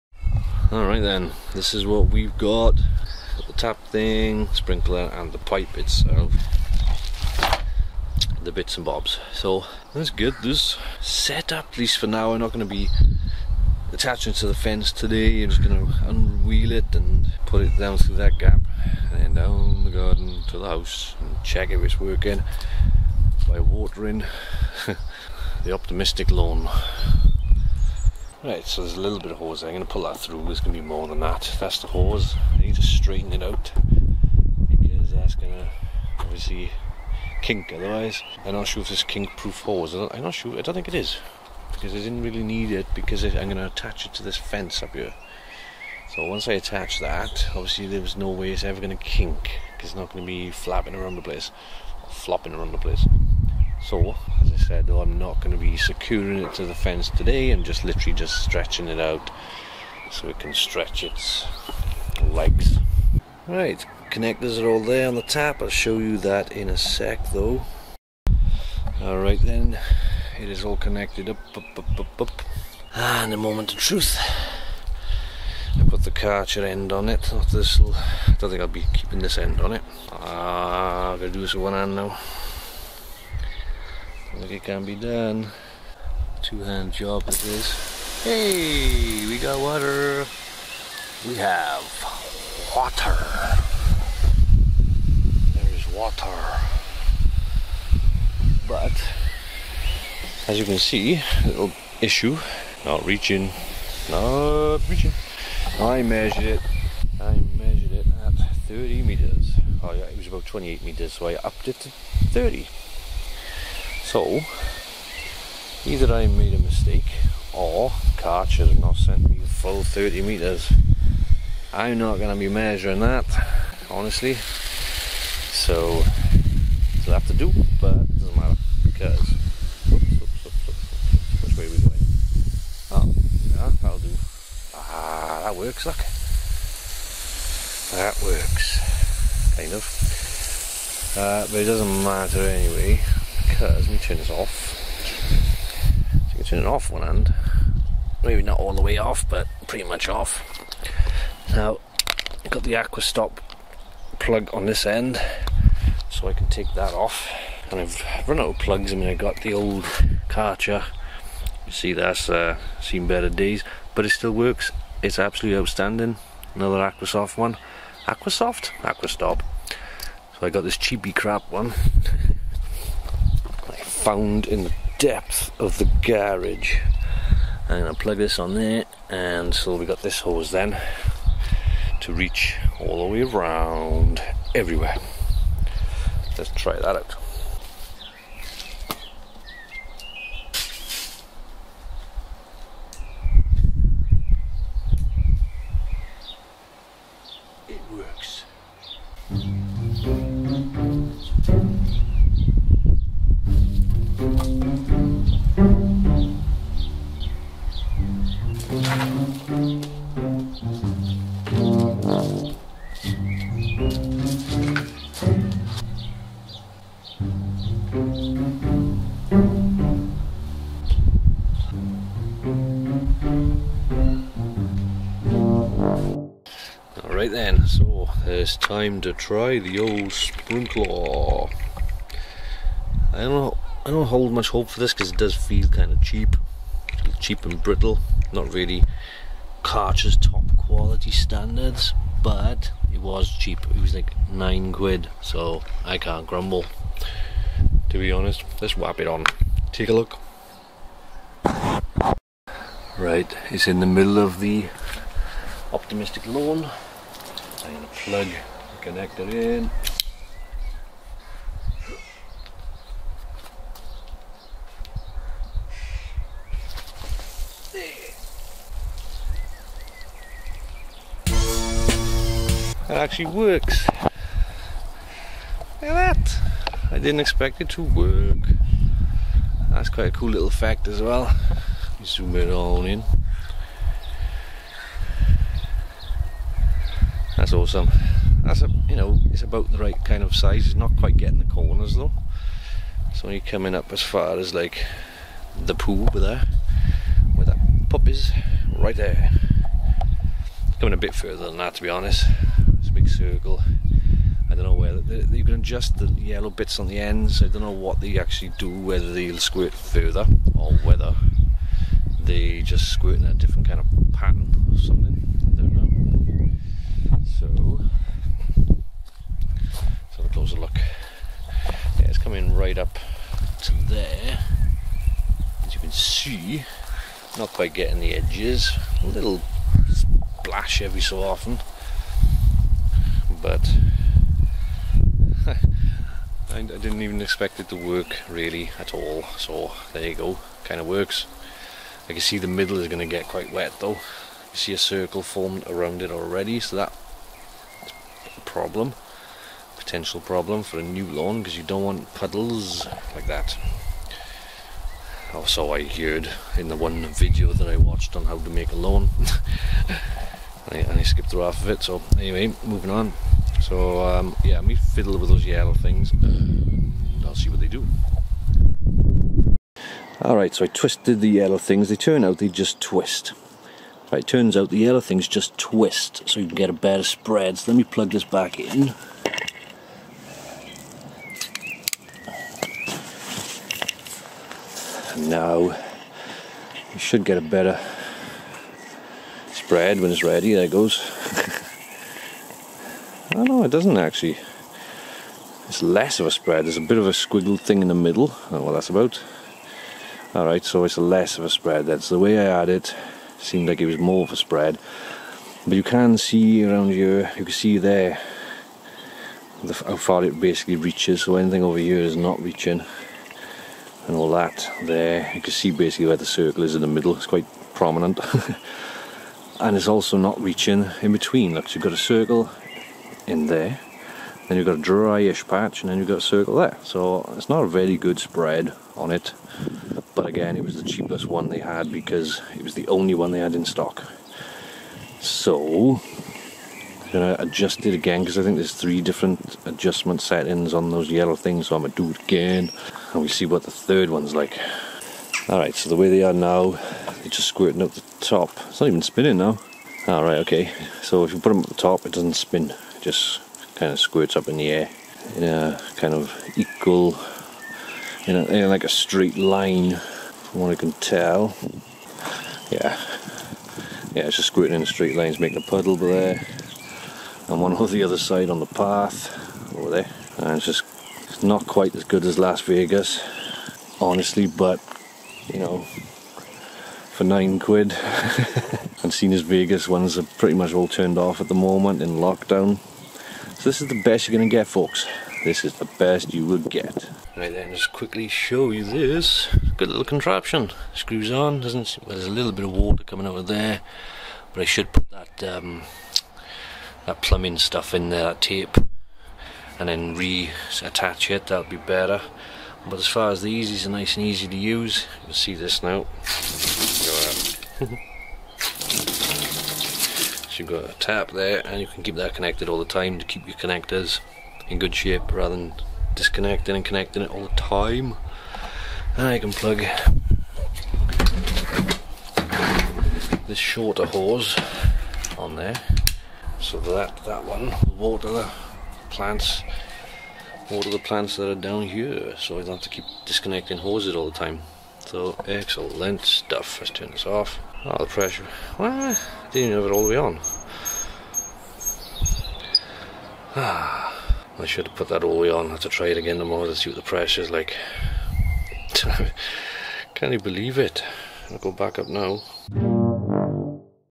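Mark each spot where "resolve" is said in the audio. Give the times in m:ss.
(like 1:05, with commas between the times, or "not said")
not said.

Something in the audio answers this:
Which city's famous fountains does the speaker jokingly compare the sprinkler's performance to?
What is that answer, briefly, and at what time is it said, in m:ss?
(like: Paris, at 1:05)
Las Vegas, at 7:52.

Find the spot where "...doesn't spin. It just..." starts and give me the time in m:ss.
7:32.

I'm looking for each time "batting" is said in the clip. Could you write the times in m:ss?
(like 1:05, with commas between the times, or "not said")
not said.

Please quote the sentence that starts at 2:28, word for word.
Maybe not all the way off, but pretty much off.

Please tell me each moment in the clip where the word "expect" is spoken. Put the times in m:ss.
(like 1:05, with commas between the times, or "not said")
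4:37, 5:37.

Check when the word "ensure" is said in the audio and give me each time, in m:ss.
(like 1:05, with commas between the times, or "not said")
not said.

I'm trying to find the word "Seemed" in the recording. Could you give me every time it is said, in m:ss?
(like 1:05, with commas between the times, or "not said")
6:43.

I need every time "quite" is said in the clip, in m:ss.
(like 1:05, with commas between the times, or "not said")
4:39, 4:50, 5:27, 5:43, 6:57, 7:51.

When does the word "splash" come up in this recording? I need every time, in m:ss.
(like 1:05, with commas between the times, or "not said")
5:29.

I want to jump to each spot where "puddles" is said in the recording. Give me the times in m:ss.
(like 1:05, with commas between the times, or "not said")
5:52, 7:45.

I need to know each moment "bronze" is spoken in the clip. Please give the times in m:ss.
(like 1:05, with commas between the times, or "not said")
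not said.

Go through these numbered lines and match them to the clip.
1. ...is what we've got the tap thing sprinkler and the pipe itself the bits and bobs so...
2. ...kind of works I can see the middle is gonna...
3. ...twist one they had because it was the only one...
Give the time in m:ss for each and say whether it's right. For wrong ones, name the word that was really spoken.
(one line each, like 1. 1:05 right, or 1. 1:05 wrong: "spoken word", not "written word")
1. 0:01 right
2. 5:40 right
3. 7:10 wrong: "cheapest", not "twist".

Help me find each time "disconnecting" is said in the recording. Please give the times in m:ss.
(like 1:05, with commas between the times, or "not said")
8:36, 8:53.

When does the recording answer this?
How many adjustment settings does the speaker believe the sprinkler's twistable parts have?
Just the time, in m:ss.
7:18.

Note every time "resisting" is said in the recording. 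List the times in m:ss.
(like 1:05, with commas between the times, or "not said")
not said.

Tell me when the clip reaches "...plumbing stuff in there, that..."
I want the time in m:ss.
8:17.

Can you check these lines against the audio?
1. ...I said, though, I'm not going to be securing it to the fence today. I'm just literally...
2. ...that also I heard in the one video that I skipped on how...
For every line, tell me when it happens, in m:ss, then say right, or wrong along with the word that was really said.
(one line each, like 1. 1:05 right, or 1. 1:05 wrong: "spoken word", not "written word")
1. 0:54 right
2. 5:53 wrong: "watched", not "skipped".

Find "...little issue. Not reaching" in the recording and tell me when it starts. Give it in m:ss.
1:41.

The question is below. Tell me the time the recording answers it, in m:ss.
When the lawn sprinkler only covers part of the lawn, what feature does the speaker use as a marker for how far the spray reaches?
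4:55.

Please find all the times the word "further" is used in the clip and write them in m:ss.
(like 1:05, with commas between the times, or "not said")
5:01, 5:09.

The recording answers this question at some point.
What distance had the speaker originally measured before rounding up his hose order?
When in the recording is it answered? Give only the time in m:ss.
1:50.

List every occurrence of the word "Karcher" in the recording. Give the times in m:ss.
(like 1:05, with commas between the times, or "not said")
1:16, 1:58, 2:40, 3:59.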